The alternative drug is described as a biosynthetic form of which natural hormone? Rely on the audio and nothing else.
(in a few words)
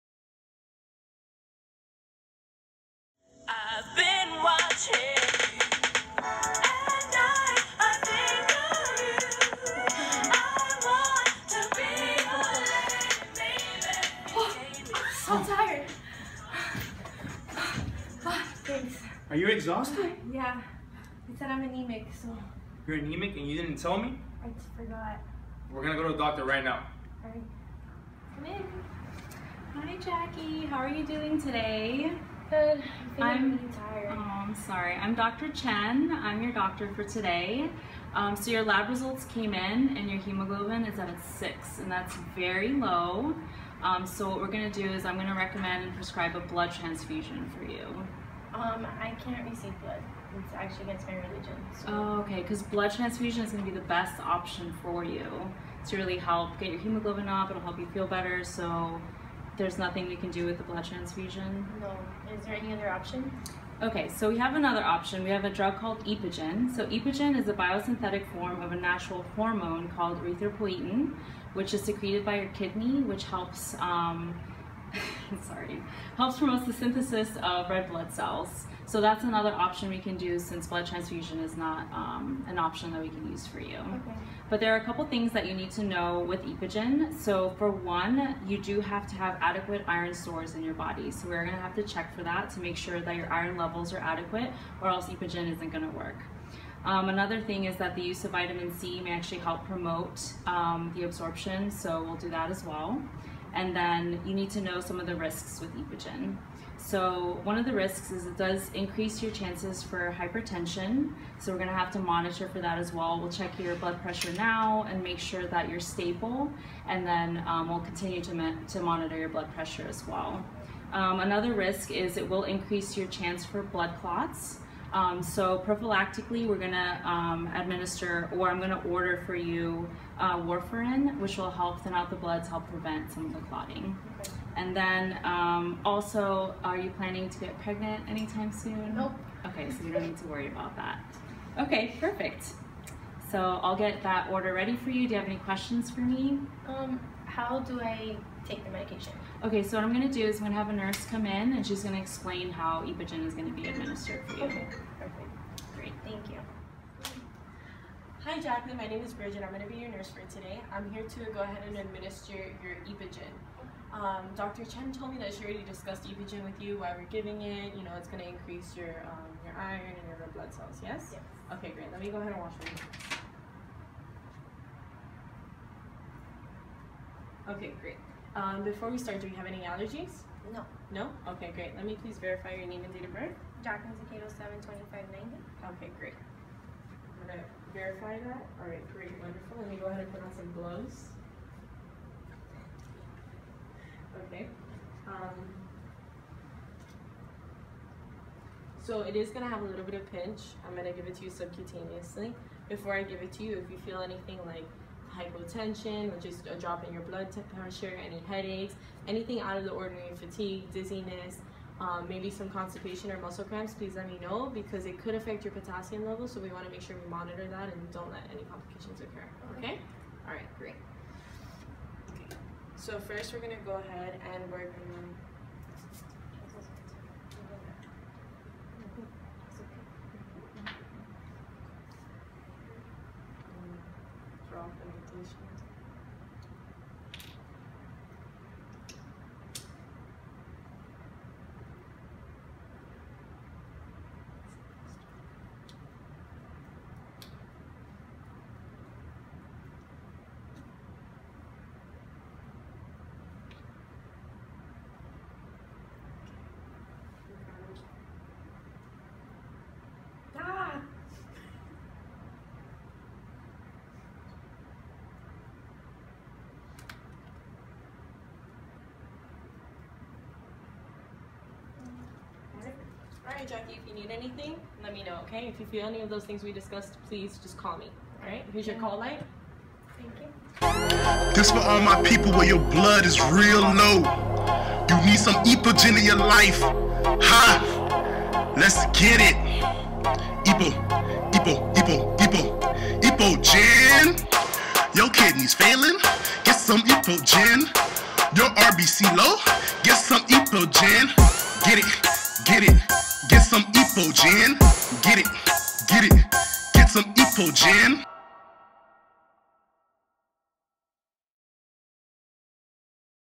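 erythropoietin.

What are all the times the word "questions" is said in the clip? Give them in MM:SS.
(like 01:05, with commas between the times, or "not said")
02:25.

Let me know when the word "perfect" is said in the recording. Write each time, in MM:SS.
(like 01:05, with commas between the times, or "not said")
02:22, 02:34.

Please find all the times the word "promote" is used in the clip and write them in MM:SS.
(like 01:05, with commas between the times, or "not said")
01:16, 01:39.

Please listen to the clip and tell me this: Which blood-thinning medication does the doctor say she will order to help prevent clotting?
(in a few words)
warfarin.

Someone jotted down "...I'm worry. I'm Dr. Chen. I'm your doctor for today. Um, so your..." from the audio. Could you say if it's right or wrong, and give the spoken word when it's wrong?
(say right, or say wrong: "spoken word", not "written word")
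wrong: "sorry", not "worry".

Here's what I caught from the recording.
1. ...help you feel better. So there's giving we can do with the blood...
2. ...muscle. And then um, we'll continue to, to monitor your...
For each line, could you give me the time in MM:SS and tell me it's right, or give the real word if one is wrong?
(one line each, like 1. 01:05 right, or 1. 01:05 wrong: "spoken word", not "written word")
1. 00:57 wrong: "nothing", not "giving"
2. 01:55 wrong: "stable", not "muscle".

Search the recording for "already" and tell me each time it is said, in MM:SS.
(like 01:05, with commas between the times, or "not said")
02:45.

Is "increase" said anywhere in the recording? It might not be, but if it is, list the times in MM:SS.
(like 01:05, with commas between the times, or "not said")
01:48, 02:02, 02:48.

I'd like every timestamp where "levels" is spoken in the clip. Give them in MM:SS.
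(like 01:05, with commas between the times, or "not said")
01:33, 03:36.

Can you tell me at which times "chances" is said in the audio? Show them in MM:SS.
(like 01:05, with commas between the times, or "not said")
01:49, 02:03.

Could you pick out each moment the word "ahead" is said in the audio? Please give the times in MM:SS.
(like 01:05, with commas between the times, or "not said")
02:41, 02:52, 03:09, 03:43.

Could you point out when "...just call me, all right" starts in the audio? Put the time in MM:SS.
04:37.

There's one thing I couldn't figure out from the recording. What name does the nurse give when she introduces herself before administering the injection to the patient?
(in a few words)
Bridget.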